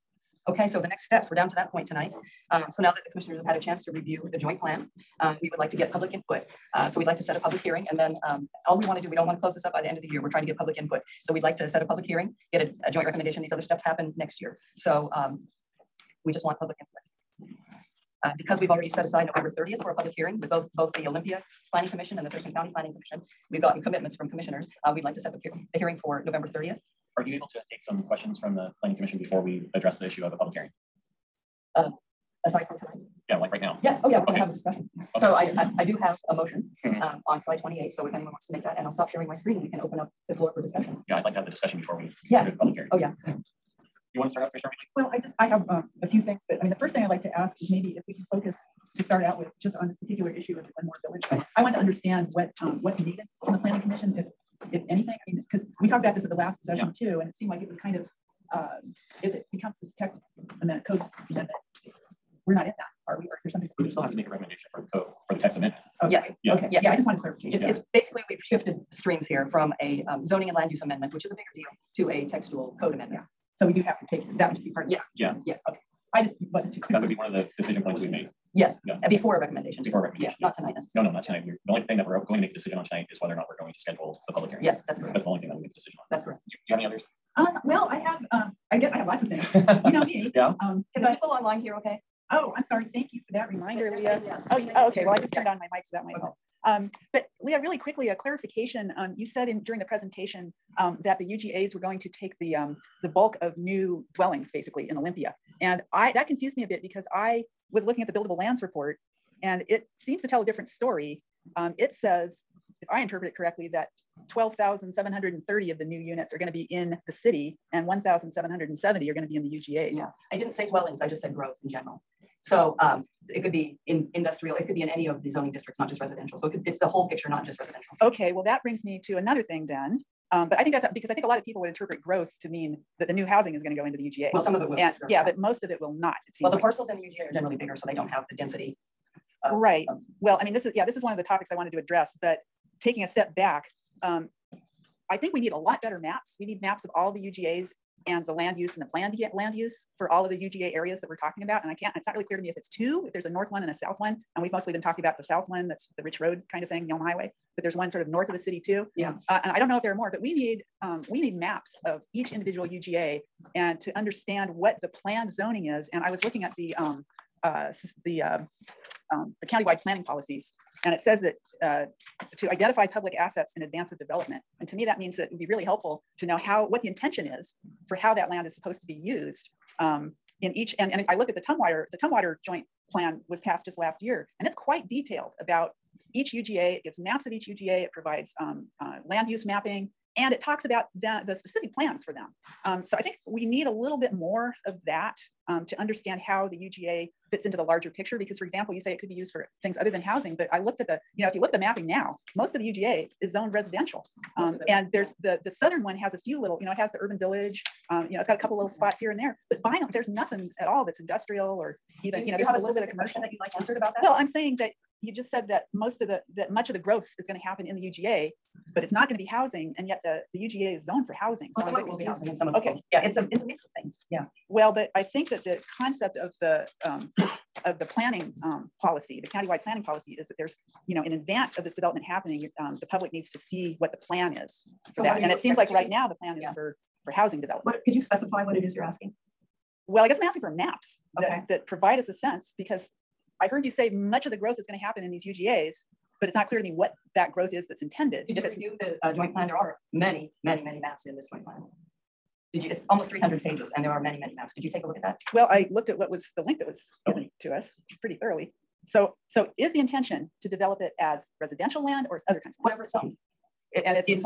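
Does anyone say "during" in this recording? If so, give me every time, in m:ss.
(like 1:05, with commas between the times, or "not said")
1:39.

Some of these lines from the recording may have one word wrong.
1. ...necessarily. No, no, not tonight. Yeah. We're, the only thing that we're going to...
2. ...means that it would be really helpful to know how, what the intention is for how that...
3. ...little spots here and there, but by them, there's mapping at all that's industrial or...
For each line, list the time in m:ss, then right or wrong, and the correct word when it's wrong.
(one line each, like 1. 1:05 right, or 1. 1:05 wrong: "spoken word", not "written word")
1. 1:20 right
2. 2:54 right
3. 3:28 wrong: "nothing", not "mapping".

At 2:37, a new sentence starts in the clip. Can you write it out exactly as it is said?
But there's one sort of north of the city too.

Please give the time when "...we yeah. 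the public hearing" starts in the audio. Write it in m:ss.
0:41.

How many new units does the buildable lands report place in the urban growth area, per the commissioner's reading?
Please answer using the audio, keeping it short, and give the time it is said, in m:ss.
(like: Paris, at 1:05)
1,770, at 1:57.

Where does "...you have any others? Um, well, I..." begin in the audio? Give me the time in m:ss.
1:26.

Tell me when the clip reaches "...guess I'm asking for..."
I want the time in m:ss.
4:00.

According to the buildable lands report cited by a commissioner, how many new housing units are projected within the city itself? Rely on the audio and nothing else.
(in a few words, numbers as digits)
12,730.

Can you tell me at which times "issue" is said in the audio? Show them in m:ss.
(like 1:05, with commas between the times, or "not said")
0:30, 0:50.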